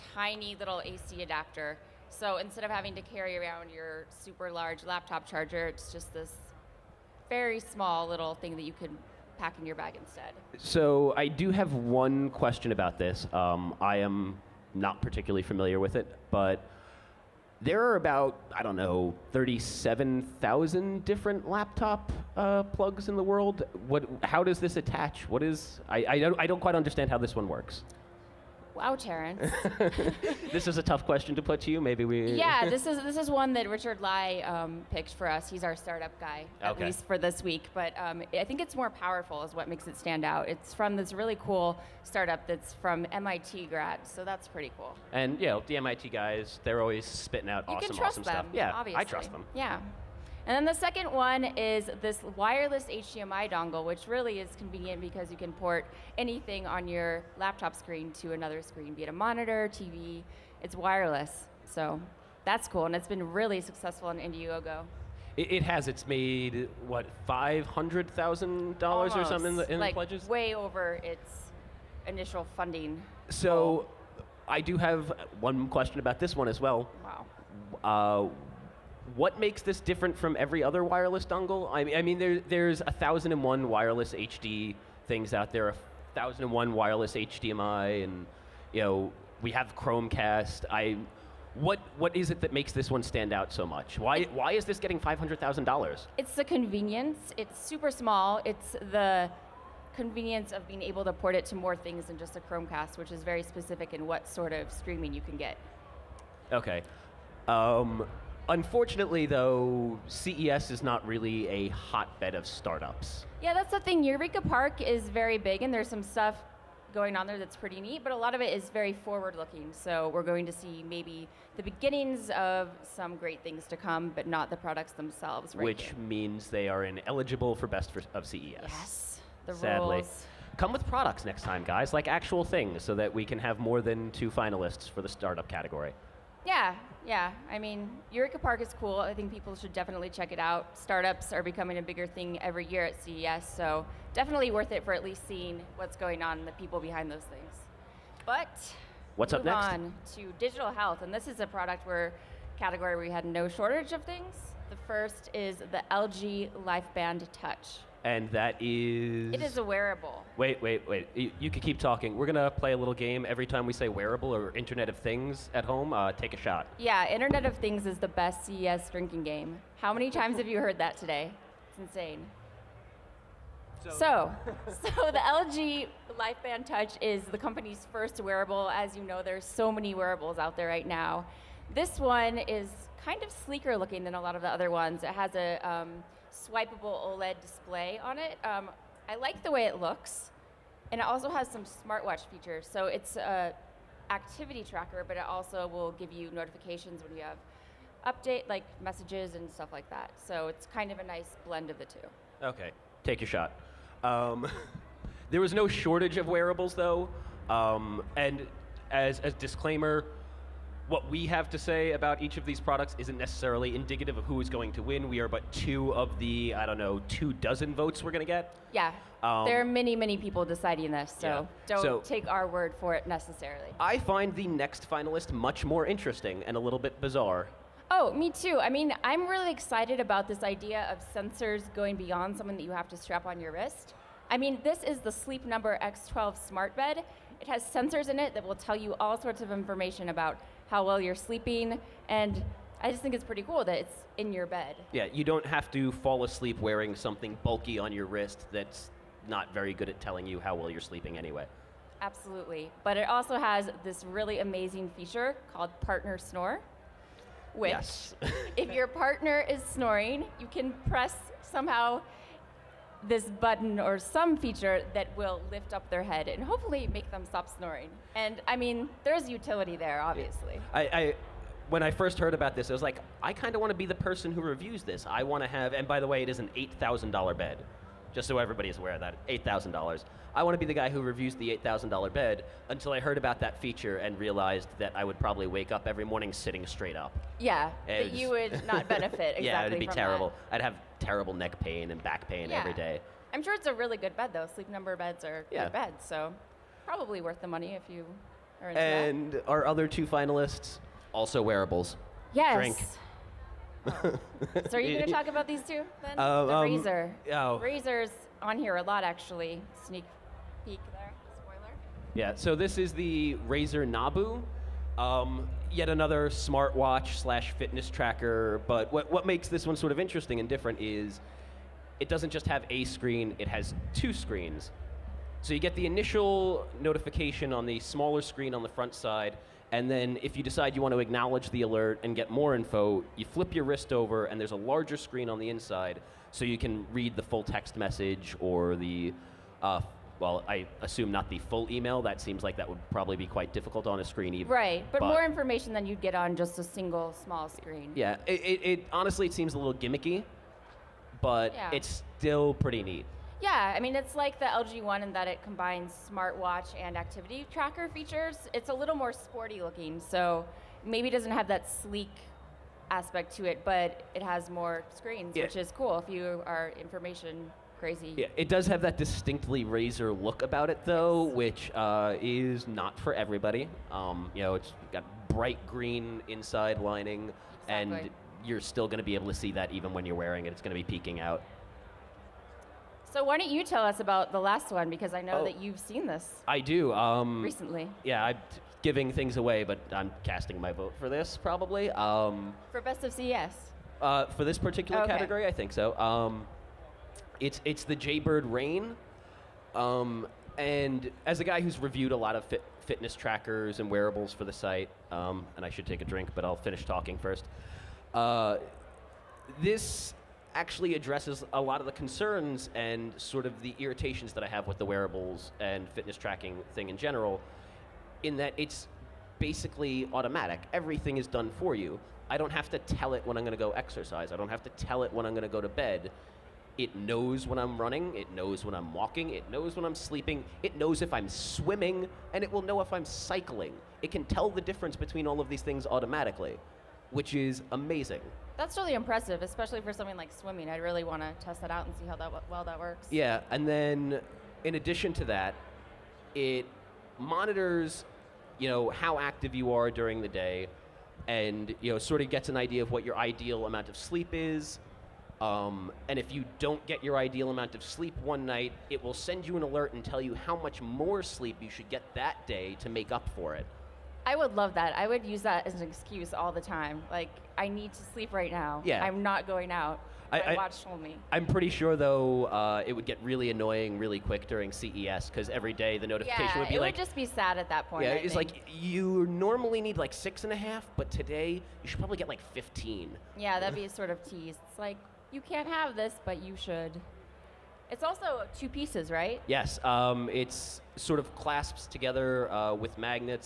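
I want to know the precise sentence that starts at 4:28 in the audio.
And I mean, there's utility there, obviously.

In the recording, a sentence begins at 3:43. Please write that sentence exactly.
I find the next finalist much more interesting and a little bit bizarre.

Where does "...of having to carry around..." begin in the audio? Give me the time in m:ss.
0:02.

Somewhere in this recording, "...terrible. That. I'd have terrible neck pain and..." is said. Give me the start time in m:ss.
4:49.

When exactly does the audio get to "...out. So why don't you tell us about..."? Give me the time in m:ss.
6:21.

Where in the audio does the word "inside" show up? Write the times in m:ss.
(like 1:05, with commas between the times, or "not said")
5:35, 6:16.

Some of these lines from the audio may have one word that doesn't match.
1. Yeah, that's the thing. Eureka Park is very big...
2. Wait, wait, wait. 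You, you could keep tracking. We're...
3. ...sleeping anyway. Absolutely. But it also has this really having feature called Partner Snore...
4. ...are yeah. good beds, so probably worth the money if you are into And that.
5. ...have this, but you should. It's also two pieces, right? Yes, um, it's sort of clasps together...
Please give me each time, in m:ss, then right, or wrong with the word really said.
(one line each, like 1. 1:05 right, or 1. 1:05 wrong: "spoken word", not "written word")
1. 1:53 right
2. 2:40 wrong: "talking", not "tracking"
3. 4:10 wrong: "amazing", not "having"
4. 4:55 right
5. 8:05 right.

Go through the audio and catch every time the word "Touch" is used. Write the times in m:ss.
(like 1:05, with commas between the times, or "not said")
2:37, 2:56.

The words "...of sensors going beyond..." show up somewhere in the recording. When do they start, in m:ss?
3:50.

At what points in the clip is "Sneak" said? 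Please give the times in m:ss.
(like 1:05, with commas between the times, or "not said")
5:09.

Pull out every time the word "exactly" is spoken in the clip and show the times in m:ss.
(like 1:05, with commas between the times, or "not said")
4:49, 6:17.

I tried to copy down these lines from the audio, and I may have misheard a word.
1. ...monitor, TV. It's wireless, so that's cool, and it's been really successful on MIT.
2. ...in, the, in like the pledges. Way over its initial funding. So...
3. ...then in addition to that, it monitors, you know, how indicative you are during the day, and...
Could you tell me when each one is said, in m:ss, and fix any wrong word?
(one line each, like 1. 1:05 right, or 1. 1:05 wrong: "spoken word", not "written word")
1. 0:59 wrong: "Indiegogo", not "MIT"
2. 1:09 right
3. 7:23 wrong: "active", not "indicative".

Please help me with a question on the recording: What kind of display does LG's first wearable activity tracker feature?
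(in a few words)
swipeable OLED display.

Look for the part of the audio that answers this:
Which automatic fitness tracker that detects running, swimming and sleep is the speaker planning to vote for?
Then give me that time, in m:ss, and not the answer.
6:37.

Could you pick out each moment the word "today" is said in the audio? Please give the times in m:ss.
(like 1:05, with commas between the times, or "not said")
2:50, 8:01.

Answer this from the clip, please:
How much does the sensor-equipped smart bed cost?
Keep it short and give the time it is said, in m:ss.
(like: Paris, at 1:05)
$8,000, at 4:36.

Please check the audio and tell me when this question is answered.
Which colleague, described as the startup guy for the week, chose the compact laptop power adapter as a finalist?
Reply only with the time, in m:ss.
0:33.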